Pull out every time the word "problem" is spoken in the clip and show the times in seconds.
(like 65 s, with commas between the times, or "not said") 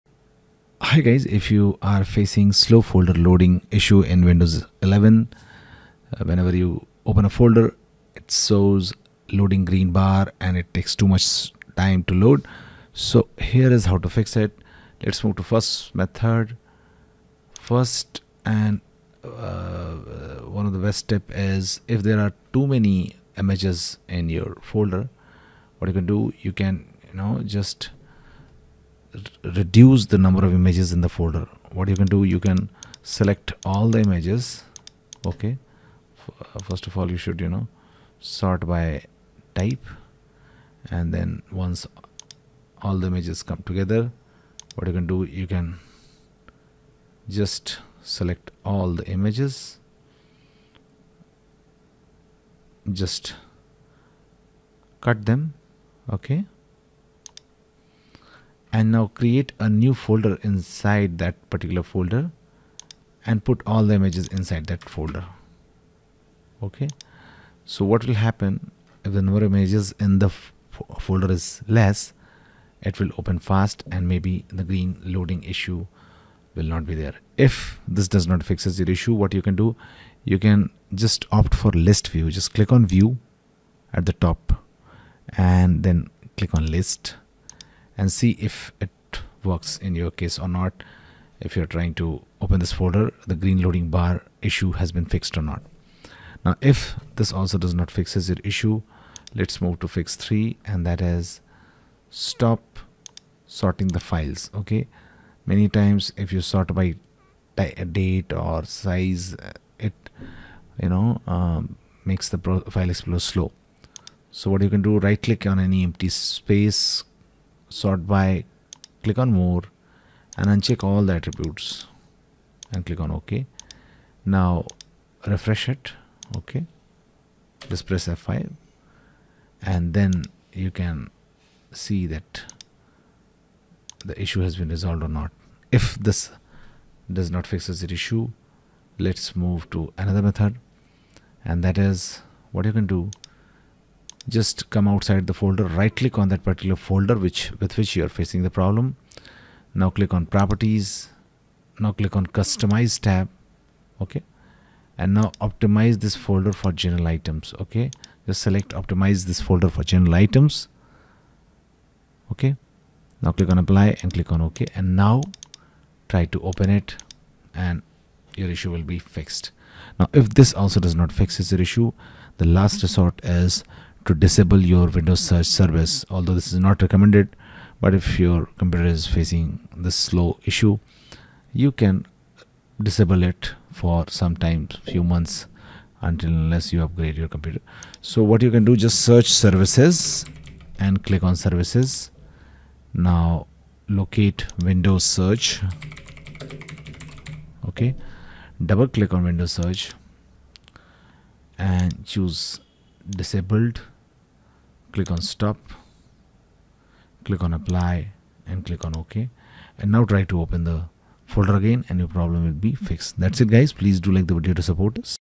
148 s, 212 s.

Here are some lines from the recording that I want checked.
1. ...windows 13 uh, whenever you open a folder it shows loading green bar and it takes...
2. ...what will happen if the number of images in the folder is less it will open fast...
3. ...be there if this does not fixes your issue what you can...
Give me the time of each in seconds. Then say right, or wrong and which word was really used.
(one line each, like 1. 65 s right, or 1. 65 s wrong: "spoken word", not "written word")
1. 4 s wrong: "11", not "13"
2. 67 s right
3. 76 s right.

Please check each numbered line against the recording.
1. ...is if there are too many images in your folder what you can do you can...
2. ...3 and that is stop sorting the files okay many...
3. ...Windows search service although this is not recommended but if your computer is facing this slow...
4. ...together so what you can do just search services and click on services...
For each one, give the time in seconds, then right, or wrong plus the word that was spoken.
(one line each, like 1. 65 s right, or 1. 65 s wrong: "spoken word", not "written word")
1. 21 s right
2. 100 s right
3. 174 s right
4. 187 s wrong: "computer", not "together".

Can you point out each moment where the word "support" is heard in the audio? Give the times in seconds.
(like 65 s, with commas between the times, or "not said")
214 s.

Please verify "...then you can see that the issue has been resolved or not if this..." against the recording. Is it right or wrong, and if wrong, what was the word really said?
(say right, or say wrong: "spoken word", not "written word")
right.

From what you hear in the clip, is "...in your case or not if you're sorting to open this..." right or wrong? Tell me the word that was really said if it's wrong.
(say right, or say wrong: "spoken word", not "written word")
wrong: "trying", not "sorting".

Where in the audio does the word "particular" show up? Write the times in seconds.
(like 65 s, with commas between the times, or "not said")
61 s, 146 s.